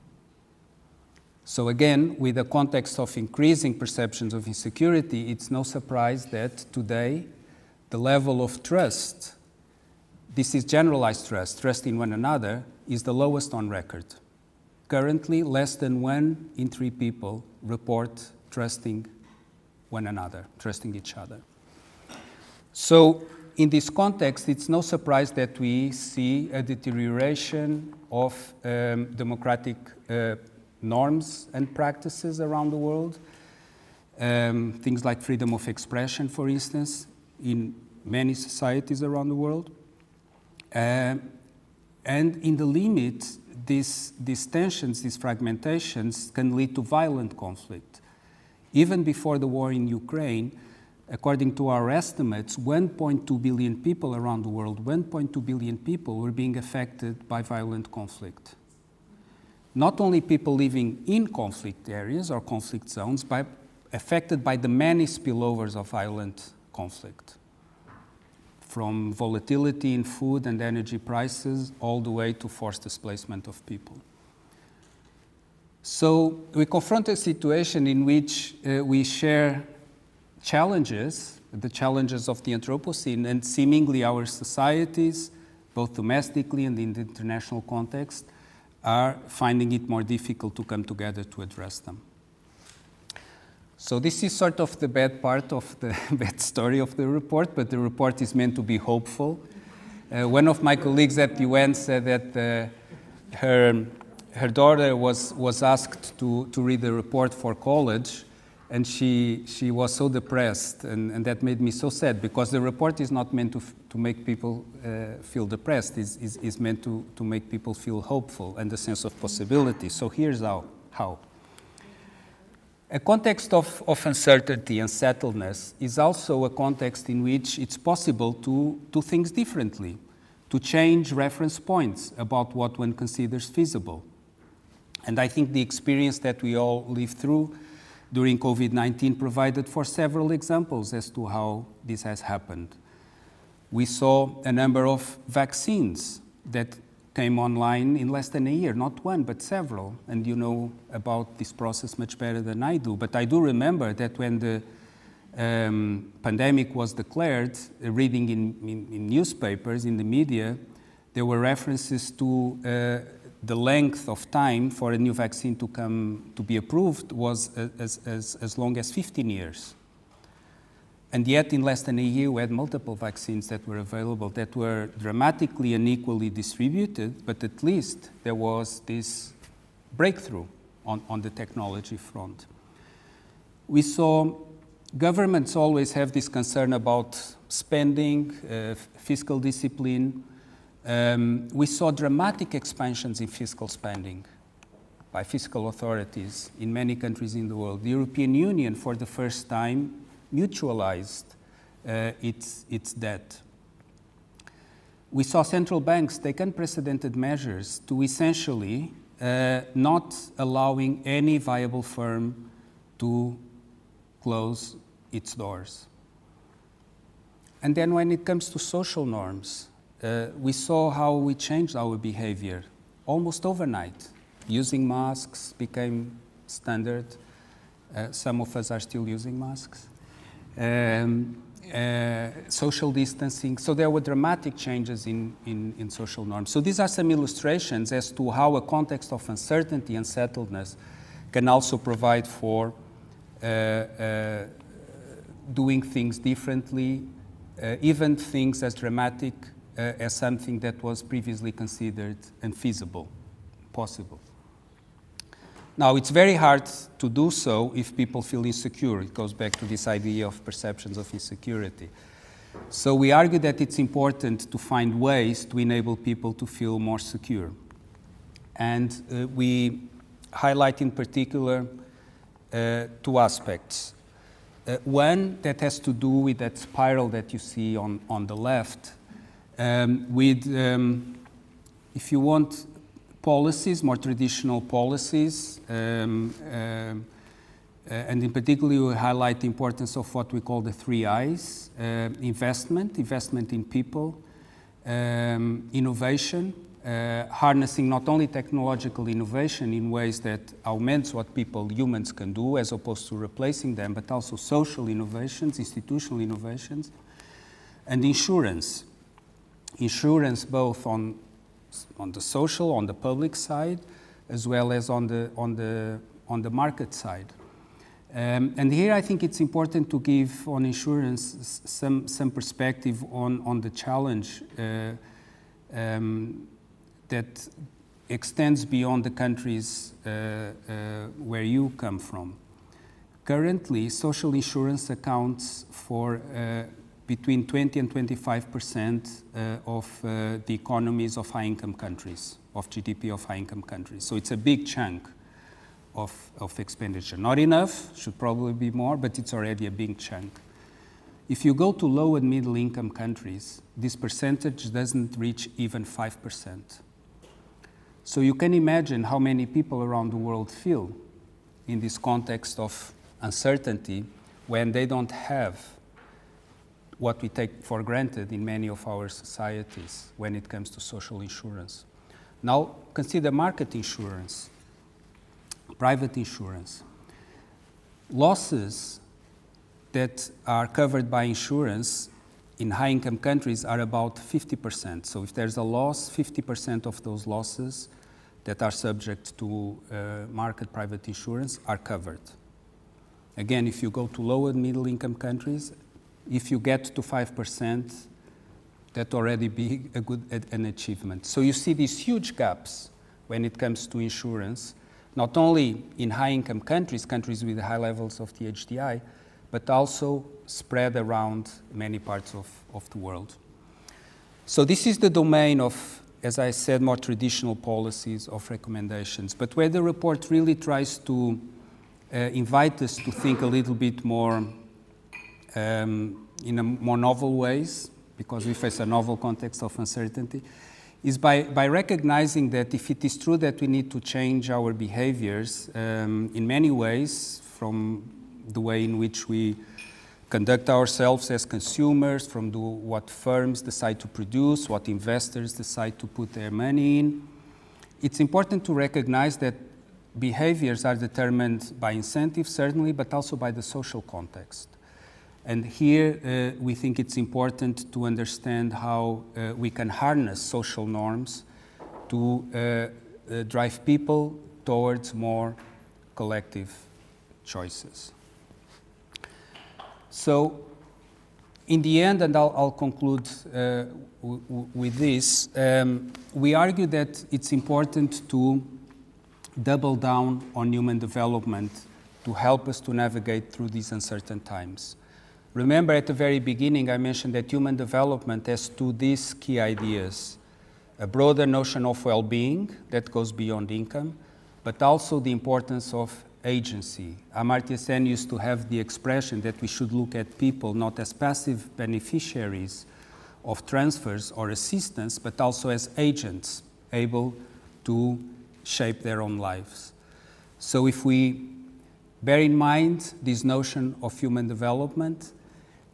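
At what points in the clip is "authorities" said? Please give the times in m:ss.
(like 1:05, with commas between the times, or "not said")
3:15.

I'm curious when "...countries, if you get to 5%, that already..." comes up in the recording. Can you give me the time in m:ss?
6:35.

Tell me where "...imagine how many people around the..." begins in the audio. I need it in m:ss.
5:58.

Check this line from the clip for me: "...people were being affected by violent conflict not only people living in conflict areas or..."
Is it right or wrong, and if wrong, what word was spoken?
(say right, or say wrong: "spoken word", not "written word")
right.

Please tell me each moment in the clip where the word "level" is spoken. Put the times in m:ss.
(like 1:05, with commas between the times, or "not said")
0:07, 6:47.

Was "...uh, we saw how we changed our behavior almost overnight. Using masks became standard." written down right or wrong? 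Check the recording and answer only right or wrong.
right.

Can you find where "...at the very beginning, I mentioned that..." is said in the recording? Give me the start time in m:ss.
8:05.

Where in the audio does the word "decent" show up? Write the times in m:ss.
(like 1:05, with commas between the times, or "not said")
not said.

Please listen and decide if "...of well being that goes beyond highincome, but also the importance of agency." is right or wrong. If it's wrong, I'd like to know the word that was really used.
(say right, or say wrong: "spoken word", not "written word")
wrong: "income", not "highincome".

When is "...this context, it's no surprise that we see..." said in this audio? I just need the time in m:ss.
0:23.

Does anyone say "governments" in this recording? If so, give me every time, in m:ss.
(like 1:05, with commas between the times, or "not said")
3:04.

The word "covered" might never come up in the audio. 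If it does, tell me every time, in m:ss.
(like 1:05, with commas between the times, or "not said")
6:20, 6:31.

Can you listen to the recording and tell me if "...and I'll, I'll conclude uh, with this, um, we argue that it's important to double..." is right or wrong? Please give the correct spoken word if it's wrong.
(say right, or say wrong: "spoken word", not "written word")
right.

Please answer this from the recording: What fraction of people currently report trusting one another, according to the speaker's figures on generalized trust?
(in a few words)
less than one in three.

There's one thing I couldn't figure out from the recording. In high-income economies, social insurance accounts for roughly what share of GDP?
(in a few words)
20 to 25 percent.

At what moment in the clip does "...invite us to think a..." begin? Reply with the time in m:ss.
7:02.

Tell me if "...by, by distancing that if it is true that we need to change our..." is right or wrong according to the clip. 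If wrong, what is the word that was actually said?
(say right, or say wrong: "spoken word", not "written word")
wrong: "recognizing", not "distancing".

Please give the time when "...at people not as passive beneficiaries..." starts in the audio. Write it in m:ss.
8:20.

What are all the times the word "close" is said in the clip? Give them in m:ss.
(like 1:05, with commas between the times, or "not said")
3:34.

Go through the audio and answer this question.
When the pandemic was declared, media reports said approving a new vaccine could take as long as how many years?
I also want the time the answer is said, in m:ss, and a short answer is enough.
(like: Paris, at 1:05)
15 years, at 2:48.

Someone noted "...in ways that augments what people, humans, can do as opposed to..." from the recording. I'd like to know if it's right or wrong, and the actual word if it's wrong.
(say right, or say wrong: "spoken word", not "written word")
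right.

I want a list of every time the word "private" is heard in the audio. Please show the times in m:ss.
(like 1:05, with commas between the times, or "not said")
6:15, 6:30.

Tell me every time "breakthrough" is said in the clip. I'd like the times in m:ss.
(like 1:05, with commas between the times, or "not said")
2:59.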